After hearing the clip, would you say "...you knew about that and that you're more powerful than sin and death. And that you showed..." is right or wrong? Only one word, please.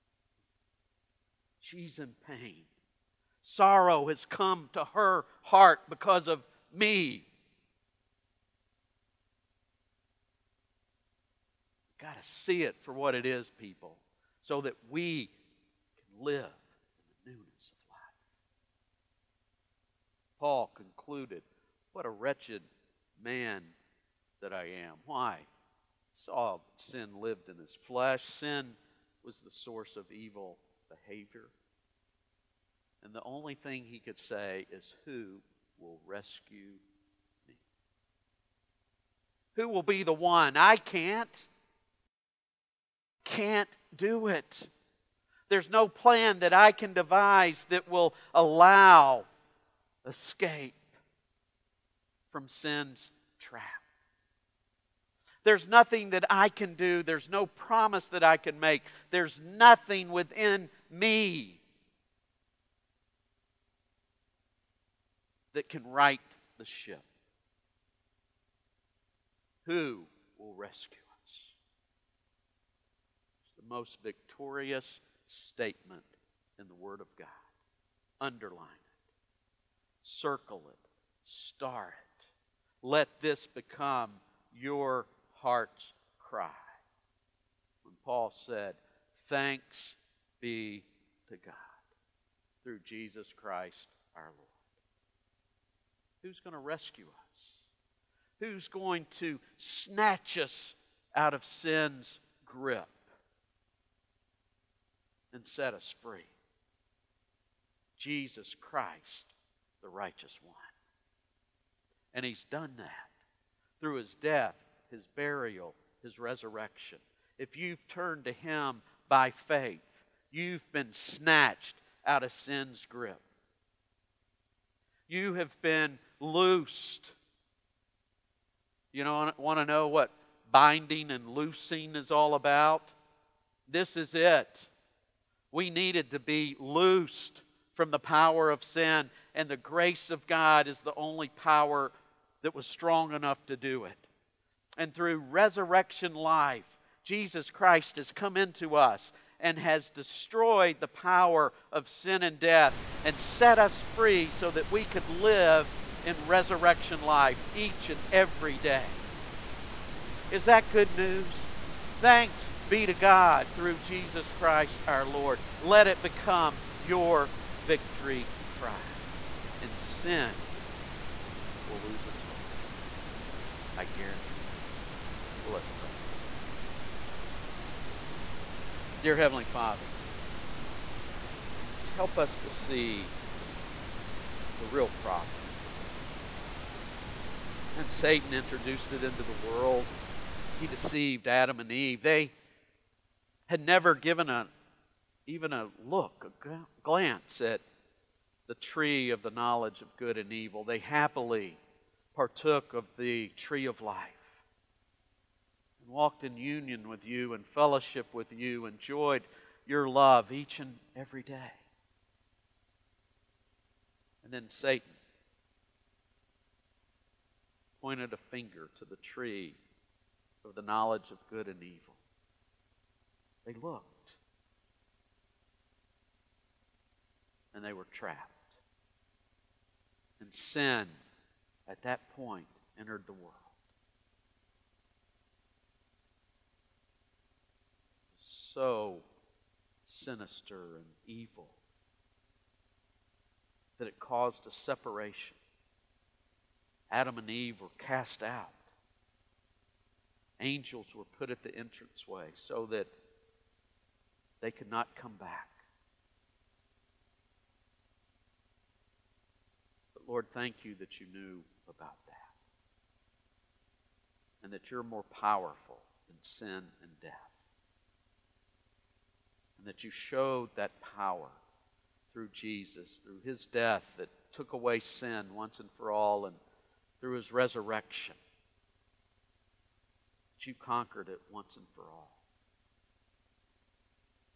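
right.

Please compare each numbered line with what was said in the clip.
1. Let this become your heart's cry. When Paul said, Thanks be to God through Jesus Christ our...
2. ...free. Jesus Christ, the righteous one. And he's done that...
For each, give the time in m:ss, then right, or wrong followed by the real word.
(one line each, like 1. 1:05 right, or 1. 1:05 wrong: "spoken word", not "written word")
1. 1:22 right
2. 1:46 right.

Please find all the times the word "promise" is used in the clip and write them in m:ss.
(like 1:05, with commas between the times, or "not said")
0:57.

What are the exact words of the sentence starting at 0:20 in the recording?
Paul concluded, What a wretched man that I am.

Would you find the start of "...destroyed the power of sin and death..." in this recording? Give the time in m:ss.
2:29.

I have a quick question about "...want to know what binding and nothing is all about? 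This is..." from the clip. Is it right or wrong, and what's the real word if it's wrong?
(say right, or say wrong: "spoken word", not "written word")
wrong: "loosing", not "nothing".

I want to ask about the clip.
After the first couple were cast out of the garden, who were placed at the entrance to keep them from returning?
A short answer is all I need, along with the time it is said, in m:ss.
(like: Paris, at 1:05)
Angels, at 4:10.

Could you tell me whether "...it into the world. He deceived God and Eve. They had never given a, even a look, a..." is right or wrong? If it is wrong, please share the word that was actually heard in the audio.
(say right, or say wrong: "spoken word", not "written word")
wrong: "Adam", not "God".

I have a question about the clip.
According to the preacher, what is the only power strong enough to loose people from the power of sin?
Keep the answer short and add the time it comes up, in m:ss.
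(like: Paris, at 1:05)
the grace of God, at 2:19.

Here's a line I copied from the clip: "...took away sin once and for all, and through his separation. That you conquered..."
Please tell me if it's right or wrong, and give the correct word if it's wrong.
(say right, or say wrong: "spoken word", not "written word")
wrong: "resurrection", not "separation".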